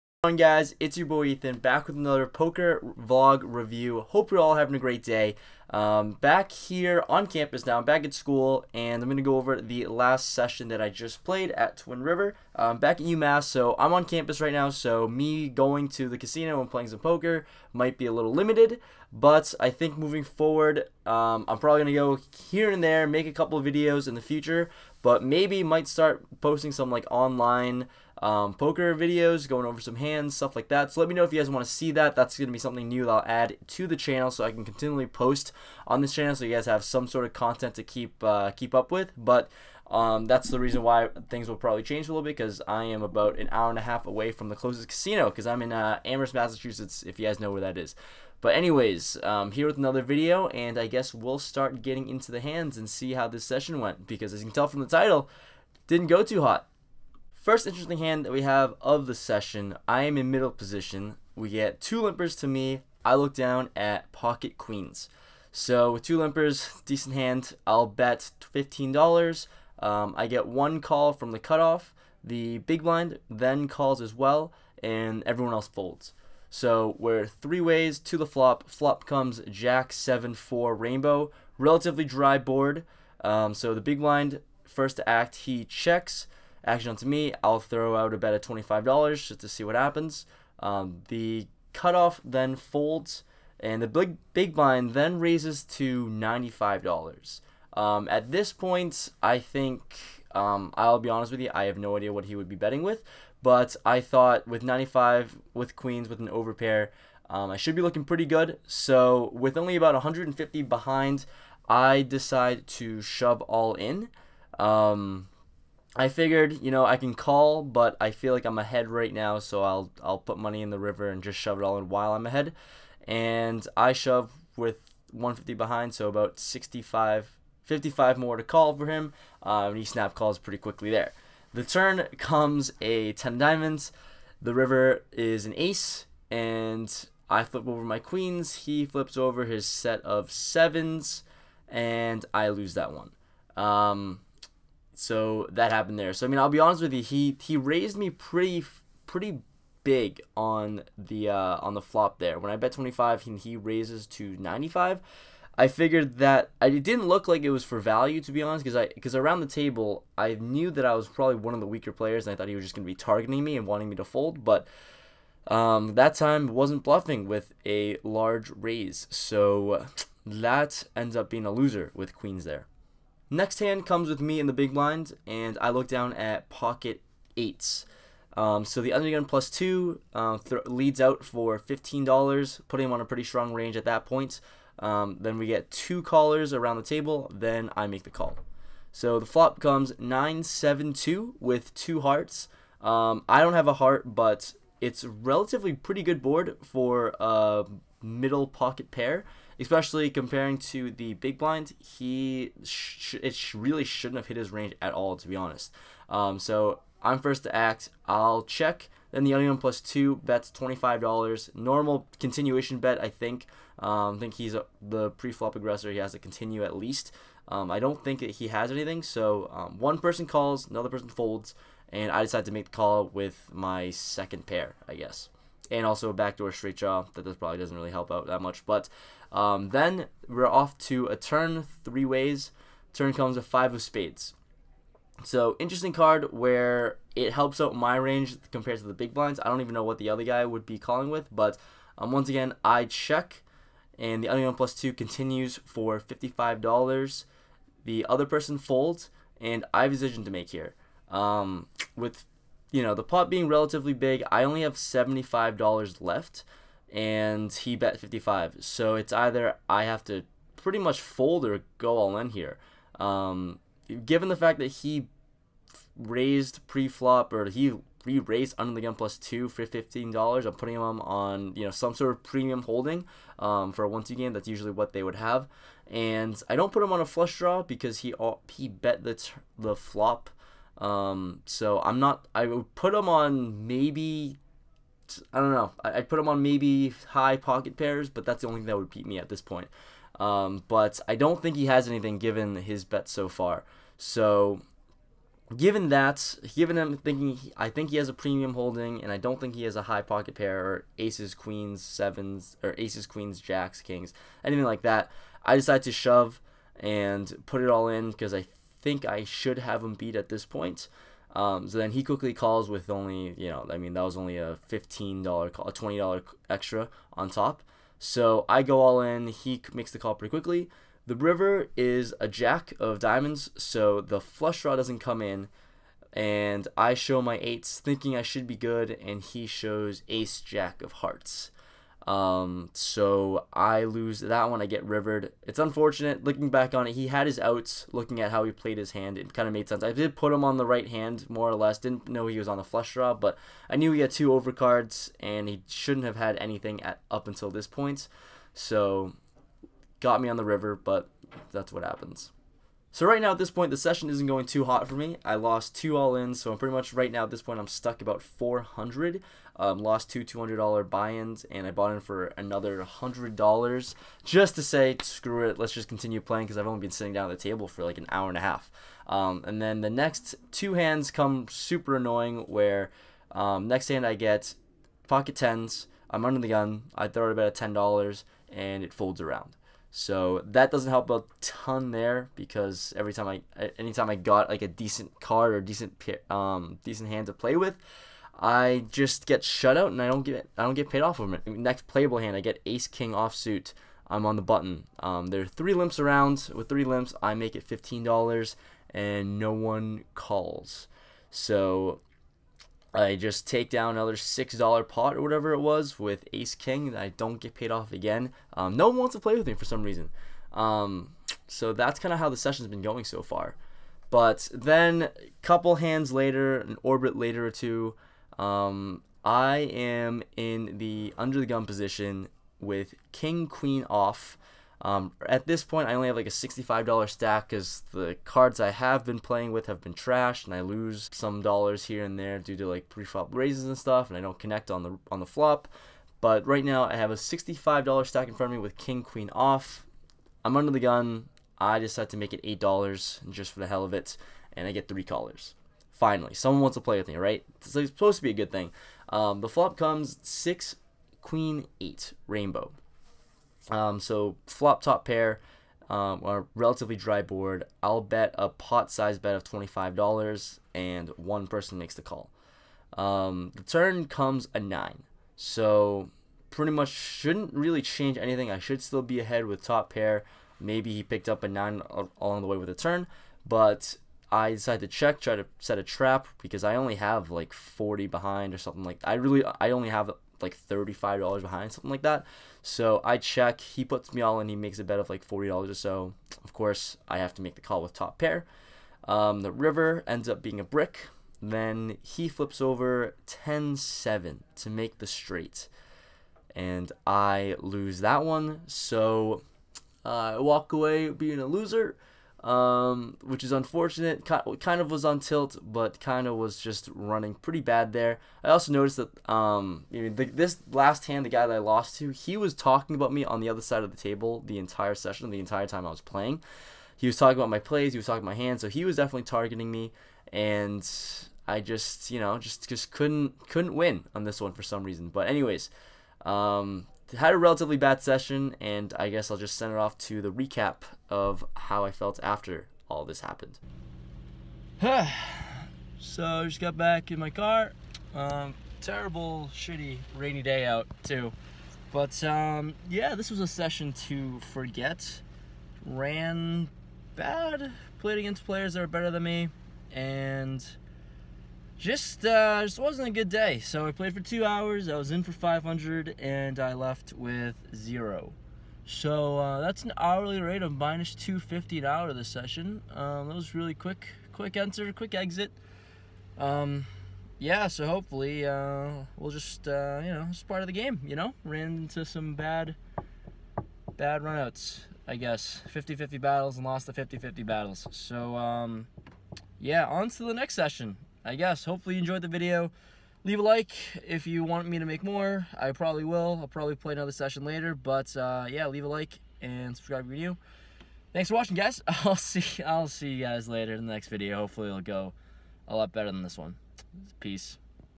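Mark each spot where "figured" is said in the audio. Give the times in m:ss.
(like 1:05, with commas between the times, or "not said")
1:56, 2:35.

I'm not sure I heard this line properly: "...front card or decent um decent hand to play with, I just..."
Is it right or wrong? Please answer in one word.
wrong.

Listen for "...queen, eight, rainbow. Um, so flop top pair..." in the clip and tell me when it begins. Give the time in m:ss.
7:31.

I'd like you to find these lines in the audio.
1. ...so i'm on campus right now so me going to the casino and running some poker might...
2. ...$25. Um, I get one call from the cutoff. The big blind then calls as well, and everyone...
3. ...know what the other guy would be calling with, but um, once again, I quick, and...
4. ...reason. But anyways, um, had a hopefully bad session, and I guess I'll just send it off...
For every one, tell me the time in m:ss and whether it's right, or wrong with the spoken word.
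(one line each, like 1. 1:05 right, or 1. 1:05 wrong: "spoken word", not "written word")
1. 0:13 wrong: "playing", not "running"
2. 1:08 wrong: "15", not "25"
3. 3:59 wrong: "check", not "quick"
4. 8:44 wrong: "relatively", not "hopefully".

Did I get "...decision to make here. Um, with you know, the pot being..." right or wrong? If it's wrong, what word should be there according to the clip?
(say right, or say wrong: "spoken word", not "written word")
right.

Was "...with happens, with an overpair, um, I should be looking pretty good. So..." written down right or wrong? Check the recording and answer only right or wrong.
wrong.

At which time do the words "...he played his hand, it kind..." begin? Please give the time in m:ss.
5:38.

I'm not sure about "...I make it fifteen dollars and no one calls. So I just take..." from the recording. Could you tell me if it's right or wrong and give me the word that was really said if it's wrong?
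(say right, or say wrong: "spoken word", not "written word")
right.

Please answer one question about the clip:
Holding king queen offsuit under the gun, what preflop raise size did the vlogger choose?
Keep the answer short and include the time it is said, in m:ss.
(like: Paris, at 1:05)
$8, at 7:22.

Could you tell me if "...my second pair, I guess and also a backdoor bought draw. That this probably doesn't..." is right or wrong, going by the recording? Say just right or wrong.
wrong.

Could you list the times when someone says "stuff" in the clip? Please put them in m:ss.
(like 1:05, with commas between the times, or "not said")
0:30, 7:13.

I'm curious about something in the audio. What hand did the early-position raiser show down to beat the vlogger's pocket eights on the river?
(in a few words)
ace jack of hearts.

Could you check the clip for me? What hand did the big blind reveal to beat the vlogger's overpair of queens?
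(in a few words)
set of sevens.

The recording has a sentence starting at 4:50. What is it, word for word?
Um, but I don't think he has anything given his bet so far.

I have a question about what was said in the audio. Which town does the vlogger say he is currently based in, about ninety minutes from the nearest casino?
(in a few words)
Amherst, Massachusetts.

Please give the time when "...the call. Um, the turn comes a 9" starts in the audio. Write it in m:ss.
7:41.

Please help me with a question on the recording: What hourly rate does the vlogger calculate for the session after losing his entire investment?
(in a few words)
minus 250 an hour.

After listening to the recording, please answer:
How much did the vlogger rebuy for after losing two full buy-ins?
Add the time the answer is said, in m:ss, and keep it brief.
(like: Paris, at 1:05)
$100, at 6:02.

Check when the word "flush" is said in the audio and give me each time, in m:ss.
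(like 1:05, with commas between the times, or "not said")
4:37, 5:24, 5:42.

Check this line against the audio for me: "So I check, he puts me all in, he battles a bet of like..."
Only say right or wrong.
wrong.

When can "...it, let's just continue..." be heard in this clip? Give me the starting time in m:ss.
6:05.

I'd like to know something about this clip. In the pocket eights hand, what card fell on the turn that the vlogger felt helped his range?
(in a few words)
five of spades.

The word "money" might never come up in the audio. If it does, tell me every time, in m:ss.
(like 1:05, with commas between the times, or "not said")
2:00.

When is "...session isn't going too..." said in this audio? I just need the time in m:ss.
5:53.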